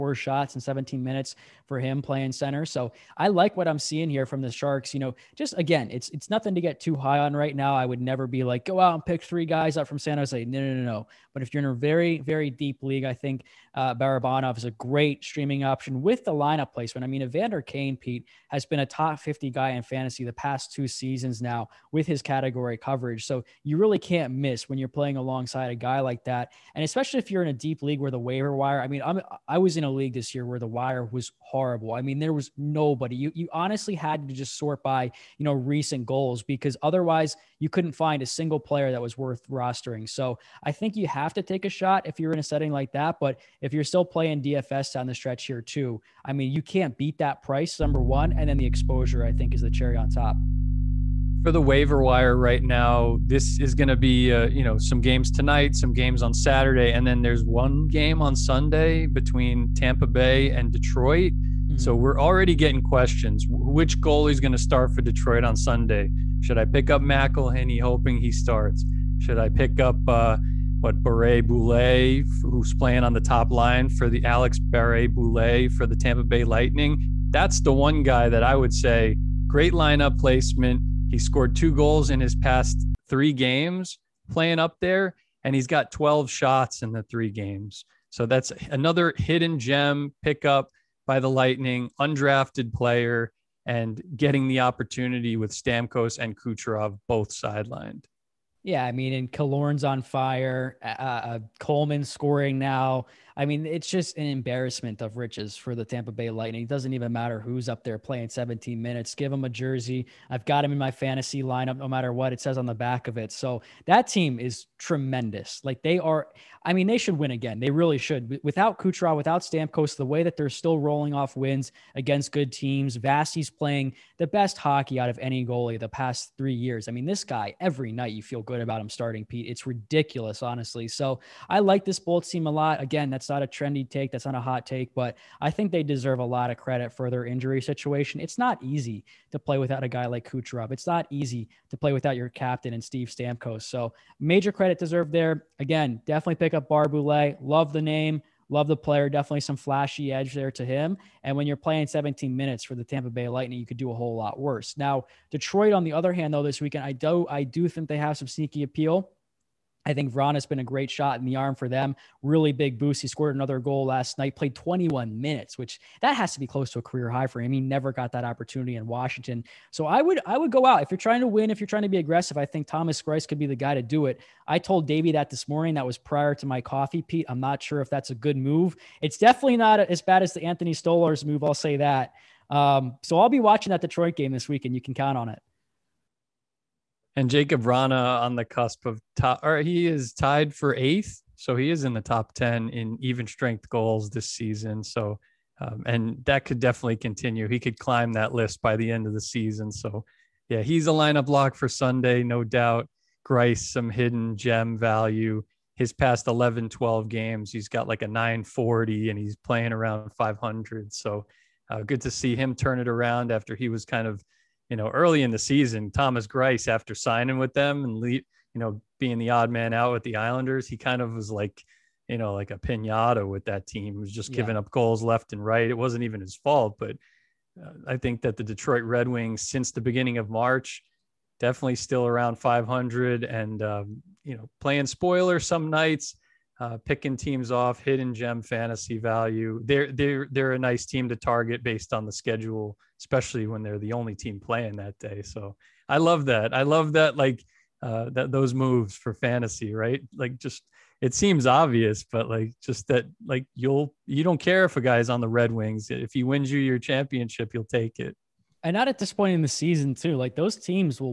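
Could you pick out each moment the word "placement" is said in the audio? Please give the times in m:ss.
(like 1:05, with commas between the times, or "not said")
0:16, 1:20.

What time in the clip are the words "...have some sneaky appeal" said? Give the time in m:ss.
2:37.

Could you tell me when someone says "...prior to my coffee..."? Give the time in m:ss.
2:55.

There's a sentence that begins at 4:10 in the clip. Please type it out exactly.
Like just it seems obvious, but like just that like you'll you don't care if a guy's on the Red Wings.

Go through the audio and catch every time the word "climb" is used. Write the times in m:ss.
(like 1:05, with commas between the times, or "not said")
3:17.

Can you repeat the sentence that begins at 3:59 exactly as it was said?
They're they're they're a nice team to target based on the schedule, especially when they're the only team playing that day.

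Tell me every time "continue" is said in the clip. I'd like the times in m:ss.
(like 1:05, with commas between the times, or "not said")
3:16.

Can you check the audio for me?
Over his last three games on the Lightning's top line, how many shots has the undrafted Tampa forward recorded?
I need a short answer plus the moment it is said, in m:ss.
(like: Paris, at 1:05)
12, at 1:25.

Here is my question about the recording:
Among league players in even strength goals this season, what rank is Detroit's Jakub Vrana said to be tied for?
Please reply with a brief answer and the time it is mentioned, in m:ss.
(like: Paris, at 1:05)
8th, at 3:10.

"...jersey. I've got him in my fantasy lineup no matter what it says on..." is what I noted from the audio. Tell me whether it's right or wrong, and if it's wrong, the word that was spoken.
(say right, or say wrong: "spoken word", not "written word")
right.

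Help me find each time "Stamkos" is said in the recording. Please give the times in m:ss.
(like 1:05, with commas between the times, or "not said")
1:35, 1:59, 2:23.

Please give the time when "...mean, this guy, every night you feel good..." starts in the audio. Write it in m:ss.
2:06.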